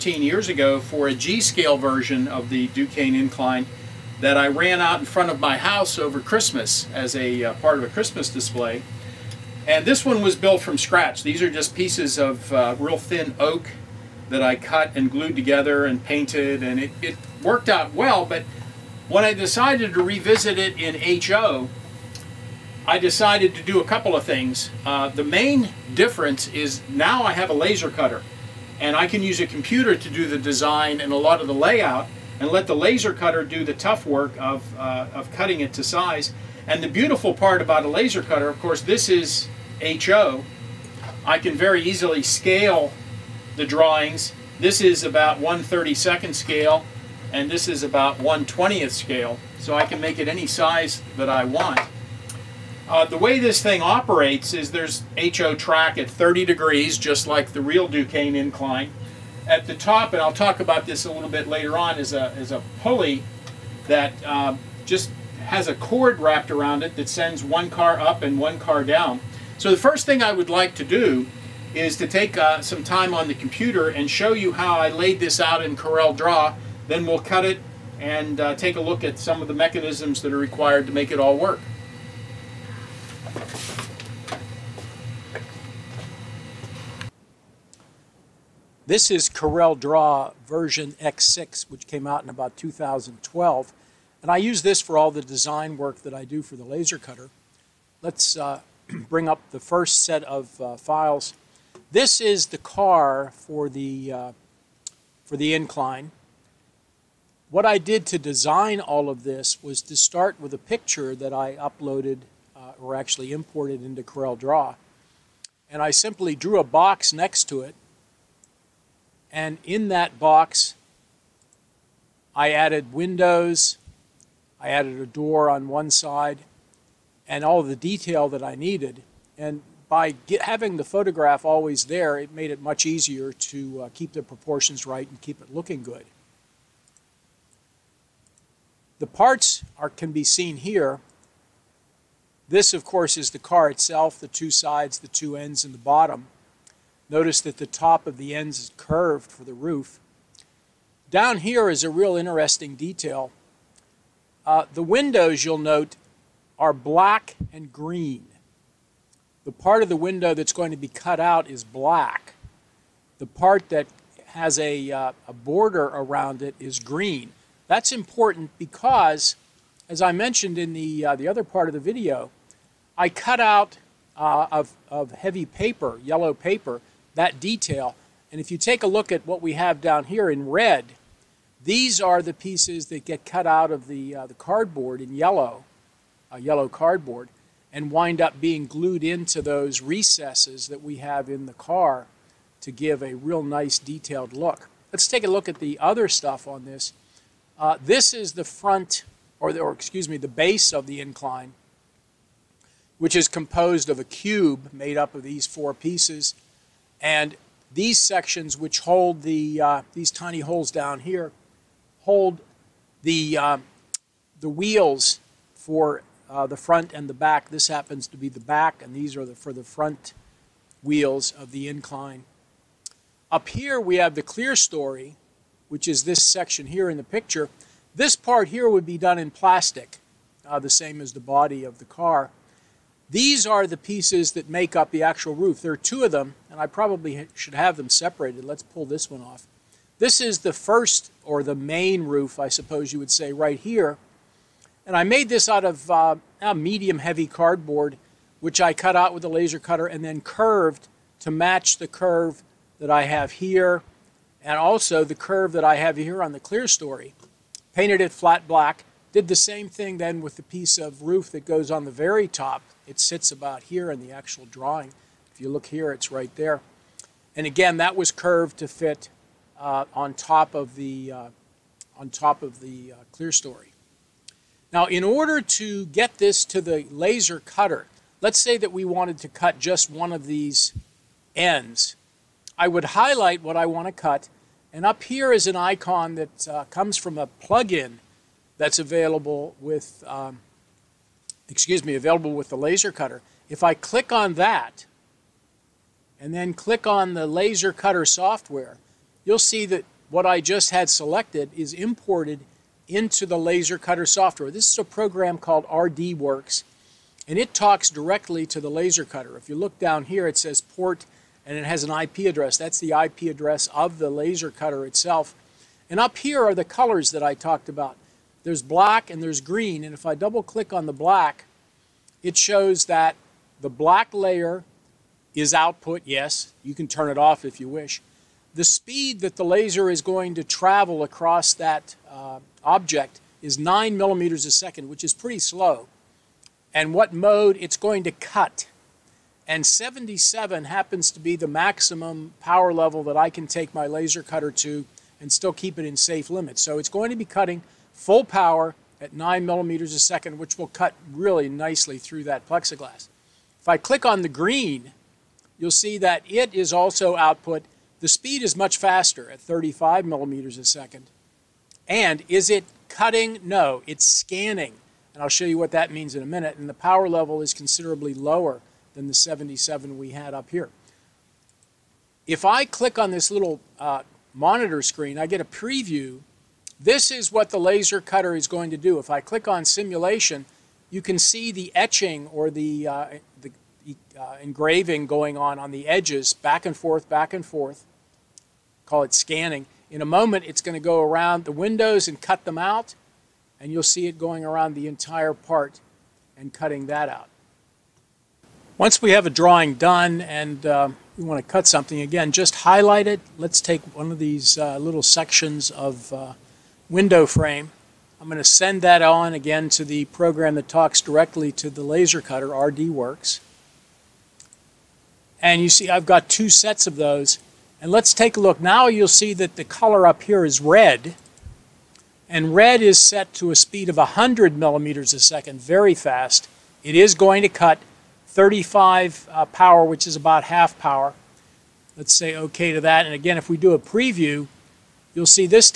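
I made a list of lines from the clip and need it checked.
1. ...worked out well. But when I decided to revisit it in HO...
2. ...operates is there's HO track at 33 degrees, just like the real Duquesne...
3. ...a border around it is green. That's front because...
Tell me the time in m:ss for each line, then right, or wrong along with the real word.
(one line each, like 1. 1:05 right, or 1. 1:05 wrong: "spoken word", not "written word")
1. 0:17 right
2. 0:53 wrong: "30", not "33"
3. 2:45 wrong: "important", not "front".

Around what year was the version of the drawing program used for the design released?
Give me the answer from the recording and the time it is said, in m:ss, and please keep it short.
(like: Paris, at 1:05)
2012, at 1:32.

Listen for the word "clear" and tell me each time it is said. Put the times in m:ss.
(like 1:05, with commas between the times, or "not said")
3:44, 4:16, 4:33.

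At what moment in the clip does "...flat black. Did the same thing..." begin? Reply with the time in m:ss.
4:18.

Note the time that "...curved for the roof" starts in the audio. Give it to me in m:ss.
2:28.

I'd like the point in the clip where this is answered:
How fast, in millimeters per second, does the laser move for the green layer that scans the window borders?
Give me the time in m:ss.
5:59.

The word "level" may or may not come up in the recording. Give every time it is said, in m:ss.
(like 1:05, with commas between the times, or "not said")
5:42, 6:07.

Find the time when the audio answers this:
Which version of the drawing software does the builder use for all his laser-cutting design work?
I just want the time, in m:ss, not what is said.
1:30.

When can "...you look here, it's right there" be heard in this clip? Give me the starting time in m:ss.
4:25.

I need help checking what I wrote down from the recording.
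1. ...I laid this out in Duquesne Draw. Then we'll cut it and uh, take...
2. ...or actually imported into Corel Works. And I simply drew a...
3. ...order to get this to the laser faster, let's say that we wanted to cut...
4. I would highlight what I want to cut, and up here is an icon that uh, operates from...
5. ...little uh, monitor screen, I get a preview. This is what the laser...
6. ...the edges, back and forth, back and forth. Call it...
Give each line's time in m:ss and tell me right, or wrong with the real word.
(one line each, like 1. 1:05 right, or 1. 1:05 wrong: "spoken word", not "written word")
1. 1:14 wrong: "Corel", not "Duquesne"
2. 1:52 wrong: "Draw", not "Works"
3. 4:35 wrong: "cutter", not "faster"
4. 4:42 wrong: "comes", not "operates"
5. 6:13 right
6. 6:25 right.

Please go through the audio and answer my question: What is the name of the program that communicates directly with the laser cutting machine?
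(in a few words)
RDWorks.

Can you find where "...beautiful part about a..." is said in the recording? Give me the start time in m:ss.
0:36.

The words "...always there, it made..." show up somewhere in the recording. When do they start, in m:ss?
2:11.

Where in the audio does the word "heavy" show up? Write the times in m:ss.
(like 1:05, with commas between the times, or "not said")
2:55, 4:06.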